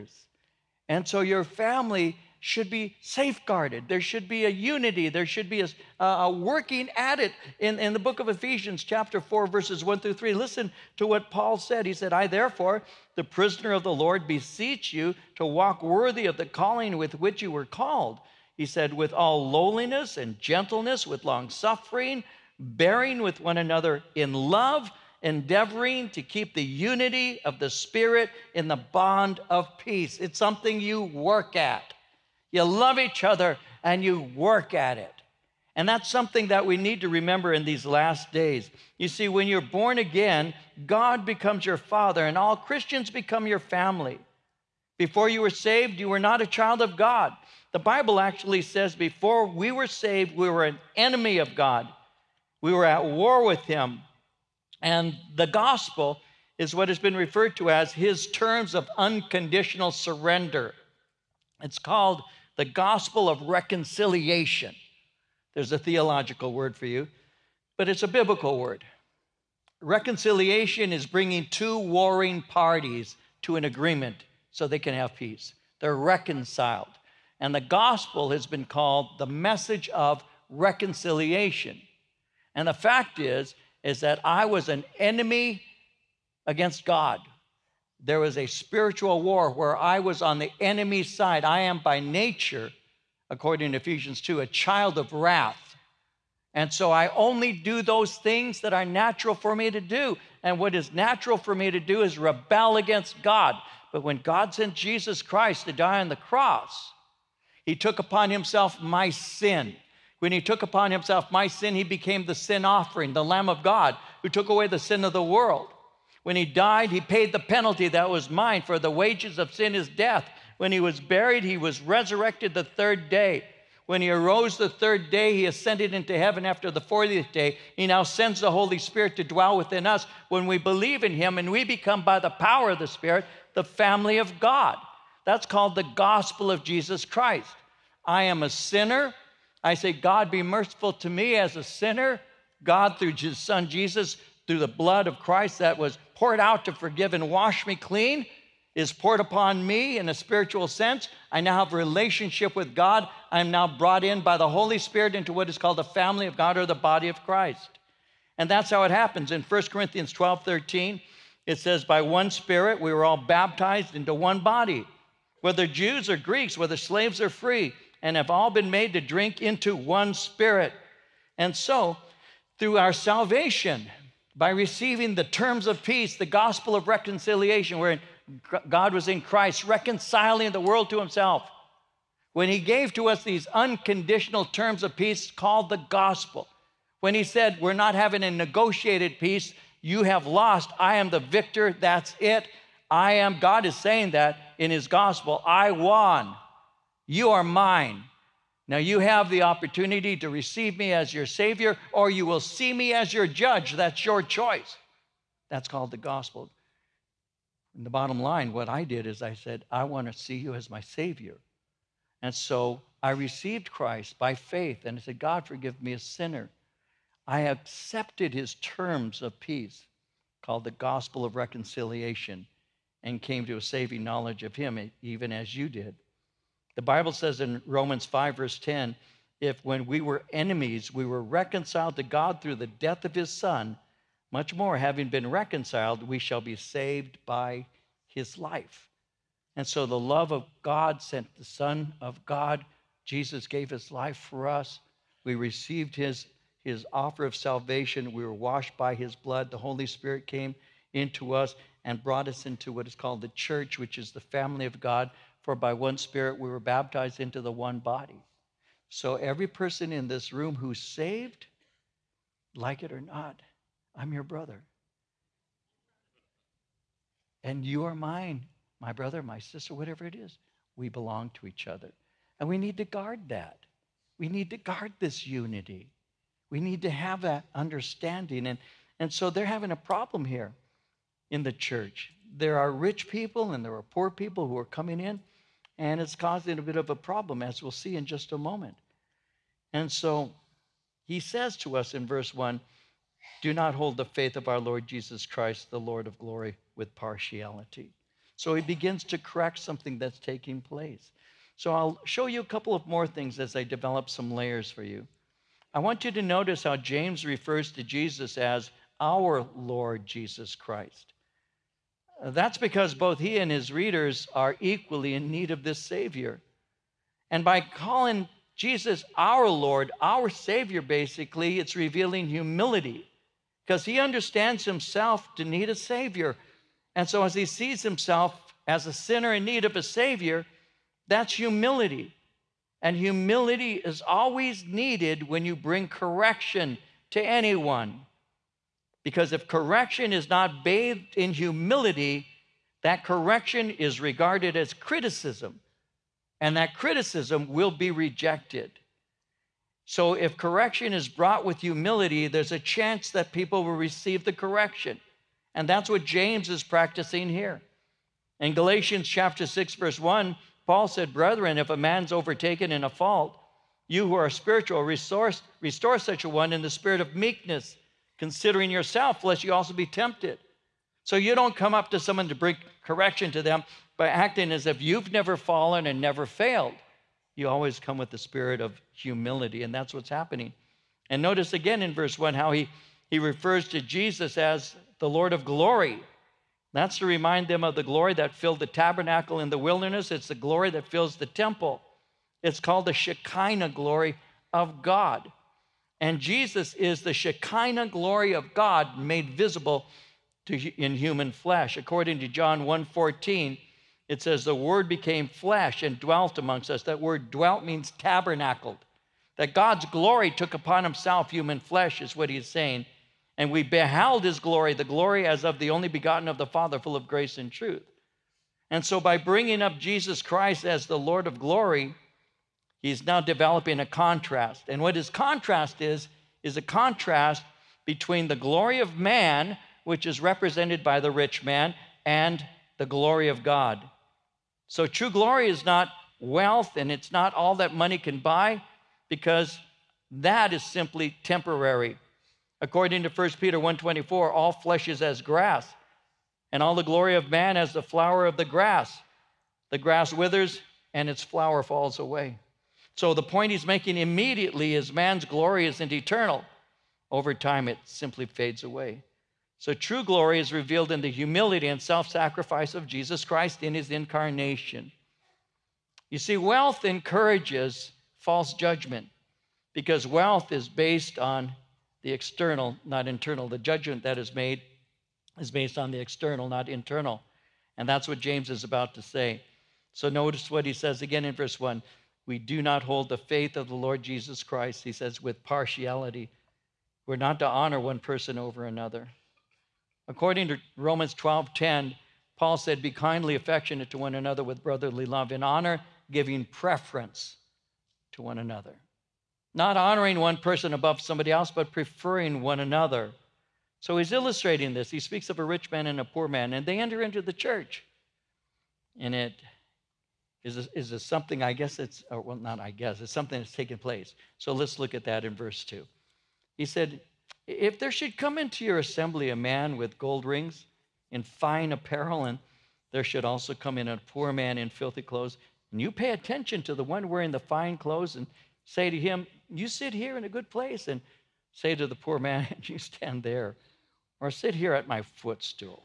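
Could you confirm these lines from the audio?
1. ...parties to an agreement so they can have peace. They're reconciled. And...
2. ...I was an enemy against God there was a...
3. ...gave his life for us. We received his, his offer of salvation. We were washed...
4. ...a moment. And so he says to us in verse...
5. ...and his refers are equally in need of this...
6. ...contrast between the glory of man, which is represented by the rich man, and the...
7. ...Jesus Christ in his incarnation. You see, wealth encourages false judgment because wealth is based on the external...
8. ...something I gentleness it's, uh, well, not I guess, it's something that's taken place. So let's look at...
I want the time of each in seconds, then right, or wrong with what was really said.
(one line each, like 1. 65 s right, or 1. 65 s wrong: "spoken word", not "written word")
1. 72 s right
2. 84 s right
3. 243 s right
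4. 288 s right
5. 313 s wrong: "readers", not "refers"
6. 426 s right
7. 462 s right
8. 511 s wrong: "guess", not "gentleness".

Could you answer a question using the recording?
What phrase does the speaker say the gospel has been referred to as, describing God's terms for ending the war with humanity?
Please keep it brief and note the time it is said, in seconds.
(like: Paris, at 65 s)
unconditional surrender, at 58 s.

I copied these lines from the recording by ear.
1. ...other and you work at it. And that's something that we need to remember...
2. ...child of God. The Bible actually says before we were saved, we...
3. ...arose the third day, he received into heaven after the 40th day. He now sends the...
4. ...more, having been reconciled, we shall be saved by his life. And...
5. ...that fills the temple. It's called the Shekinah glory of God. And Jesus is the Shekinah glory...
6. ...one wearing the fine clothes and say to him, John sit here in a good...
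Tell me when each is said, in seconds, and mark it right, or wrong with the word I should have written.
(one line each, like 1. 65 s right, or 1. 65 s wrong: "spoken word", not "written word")
1. 33 s right
2. 46 s right
3. 124 s wrong: "ascended", not "received"
4. 234 s right
5. 390 s right
6. 526 s wrong: "You", not "John".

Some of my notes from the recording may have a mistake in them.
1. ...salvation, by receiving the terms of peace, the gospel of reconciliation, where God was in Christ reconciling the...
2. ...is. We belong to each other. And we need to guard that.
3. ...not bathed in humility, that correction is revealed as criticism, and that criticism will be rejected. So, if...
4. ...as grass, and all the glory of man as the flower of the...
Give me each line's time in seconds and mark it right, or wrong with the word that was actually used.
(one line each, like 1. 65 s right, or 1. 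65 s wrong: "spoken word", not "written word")
1. 172 s right
2. 270 s right
3. 340 s wrong: "regarded", not "revealed"
4. 445 s right.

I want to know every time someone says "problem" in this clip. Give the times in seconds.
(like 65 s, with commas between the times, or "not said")
279 s, 286 s.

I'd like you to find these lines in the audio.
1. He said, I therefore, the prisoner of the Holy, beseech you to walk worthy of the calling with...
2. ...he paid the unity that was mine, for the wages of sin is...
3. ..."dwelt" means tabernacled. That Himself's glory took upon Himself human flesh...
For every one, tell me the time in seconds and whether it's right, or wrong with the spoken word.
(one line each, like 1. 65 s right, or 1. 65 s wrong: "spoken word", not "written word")
1. 11 s wrong: "Lord", not "Holy"
2. 116 s wrong: "penalty", not "unity"
3. 407 s wrong: "God", not "Himself".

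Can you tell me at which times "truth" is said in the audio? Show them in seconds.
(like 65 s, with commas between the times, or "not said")
417 s.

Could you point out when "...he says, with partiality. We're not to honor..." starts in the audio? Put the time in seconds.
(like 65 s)
484 s.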